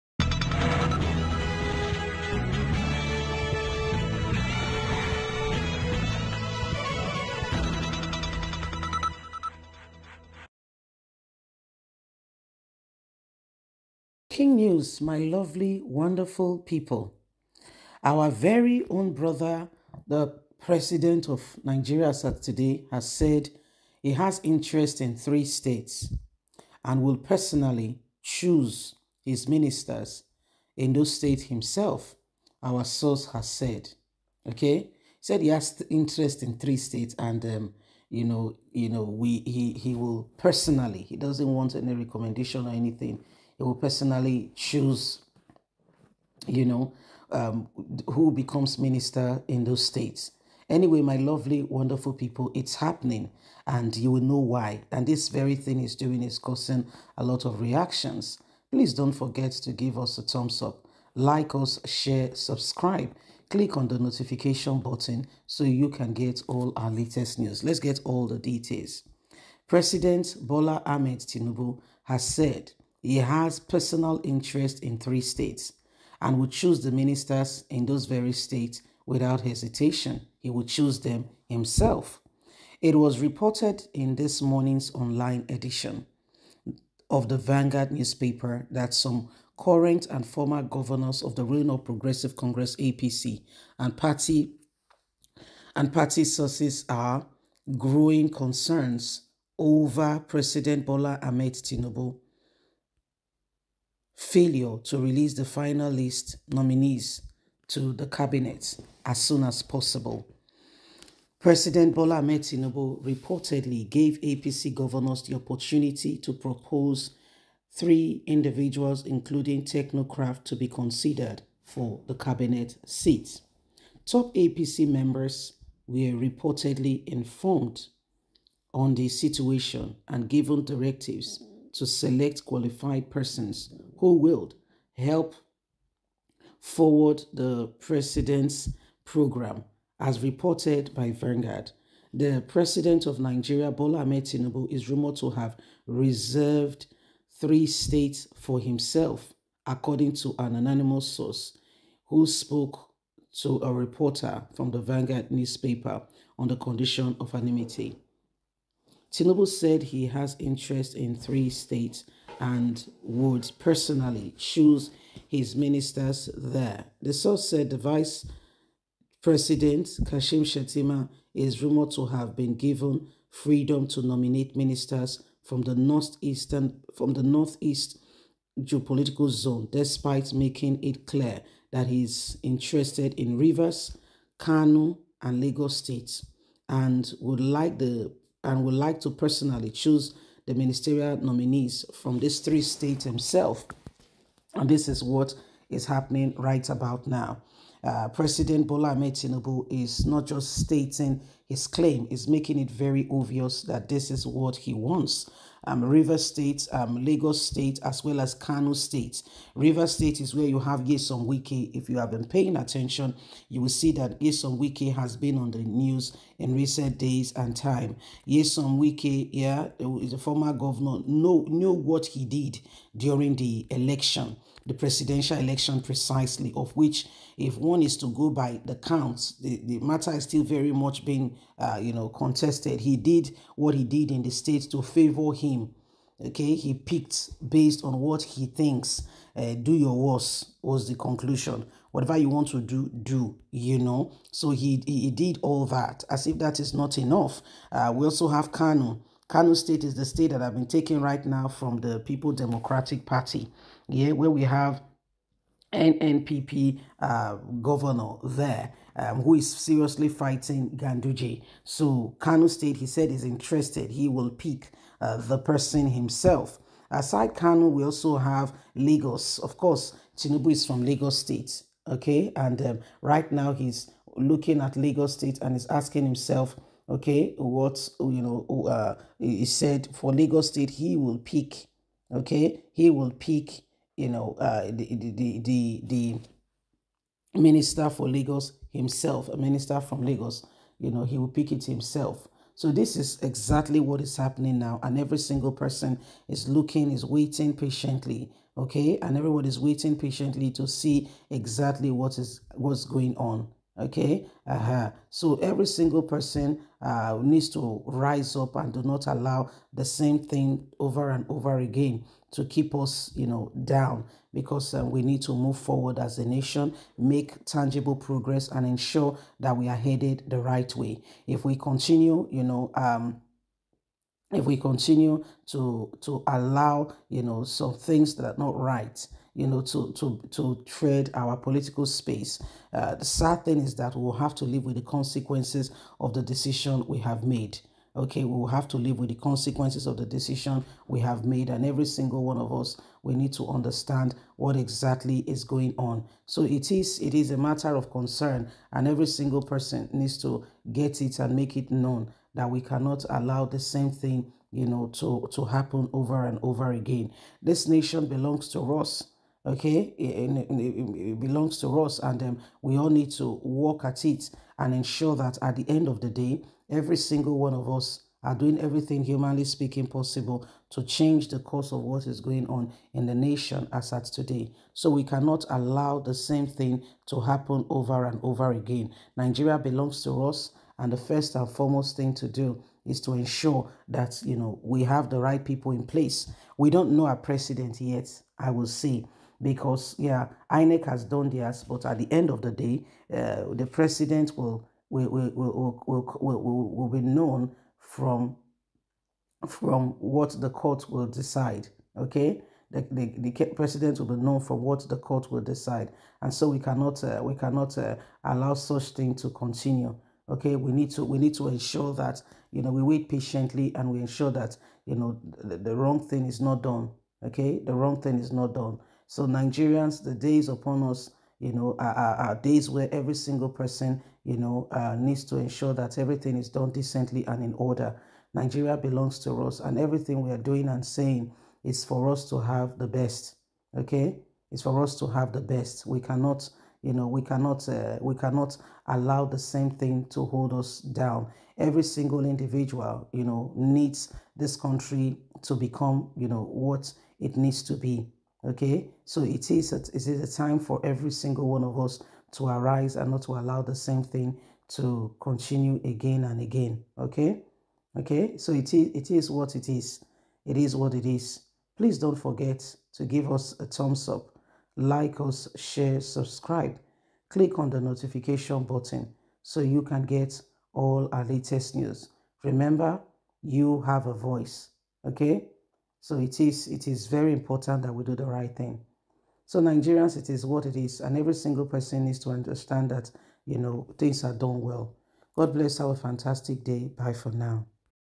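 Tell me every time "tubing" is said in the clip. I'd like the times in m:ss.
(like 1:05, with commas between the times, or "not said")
not said.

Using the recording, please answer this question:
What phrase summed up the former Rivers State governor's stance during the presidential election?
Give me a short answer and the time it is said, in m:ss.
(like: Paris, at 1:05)
do your worst, at 3:59.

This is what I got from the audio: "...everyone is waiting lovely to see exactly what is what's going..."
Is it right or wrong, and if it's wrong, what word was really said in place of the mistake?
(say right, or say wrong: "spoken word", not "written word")
wrong: "patiently", not "lovely".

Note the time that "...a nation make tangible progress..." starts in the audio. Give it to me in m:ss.
5:16.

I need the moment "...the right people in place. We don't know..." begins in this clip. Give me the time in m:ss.
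6:25.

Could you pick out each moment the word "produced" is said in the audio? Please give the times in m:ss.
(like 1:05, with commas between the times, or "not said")
not said.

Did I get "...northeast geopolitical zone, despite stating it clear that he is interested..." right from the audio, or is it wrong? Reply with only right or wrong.
wrong.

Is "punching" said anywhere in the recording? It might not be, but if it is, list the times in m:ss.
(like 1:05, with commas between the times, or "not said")
not said.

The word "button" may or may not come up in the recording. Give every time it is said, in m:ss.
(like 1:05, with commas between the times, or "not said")
1:04, 7:48.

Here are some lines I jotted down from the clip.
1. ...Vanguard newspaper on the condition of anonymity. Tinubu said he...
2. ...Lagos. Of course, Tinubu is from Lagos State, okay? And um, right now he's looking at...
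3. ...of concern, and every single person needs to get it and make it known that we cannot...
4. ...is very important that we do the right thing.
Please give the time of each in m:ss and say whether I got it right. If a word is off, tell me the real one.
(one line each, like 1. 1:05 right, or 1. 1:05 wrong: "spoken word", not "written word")
1. 2:34 right
2. 4:28 right
3. 5:47 right
4. 7:56 right.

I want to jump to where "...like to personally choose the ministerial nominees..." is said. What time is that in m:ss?
3:08.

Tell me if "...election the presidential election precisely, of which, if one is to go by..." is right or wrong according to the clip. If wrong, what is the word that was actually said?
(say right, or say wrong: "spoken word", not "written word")
right.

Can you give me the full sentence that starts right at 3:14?
And this is what is happening right about now.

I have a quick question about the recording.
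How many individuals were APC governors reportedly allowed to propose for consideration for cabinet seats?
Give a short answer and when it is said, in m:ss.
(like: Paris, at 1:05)
3, at 1:57.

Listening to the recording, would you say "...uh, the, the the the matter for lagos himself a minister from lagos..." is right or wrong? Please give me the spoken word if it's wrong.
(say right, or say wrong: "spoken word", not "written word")
wrong: "minister", not "matter".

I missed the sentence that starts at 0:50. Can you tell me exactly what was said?
Anyway, my lovely, wonderful people, it's happening and you will know why.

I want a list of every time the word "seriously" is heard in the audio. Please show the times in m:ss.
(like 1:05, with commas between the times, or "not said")
4:19.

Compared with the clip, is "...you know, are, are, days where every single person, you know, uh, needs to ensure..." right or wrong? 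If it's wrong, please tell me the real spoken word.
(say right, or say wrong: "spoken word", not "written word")
right.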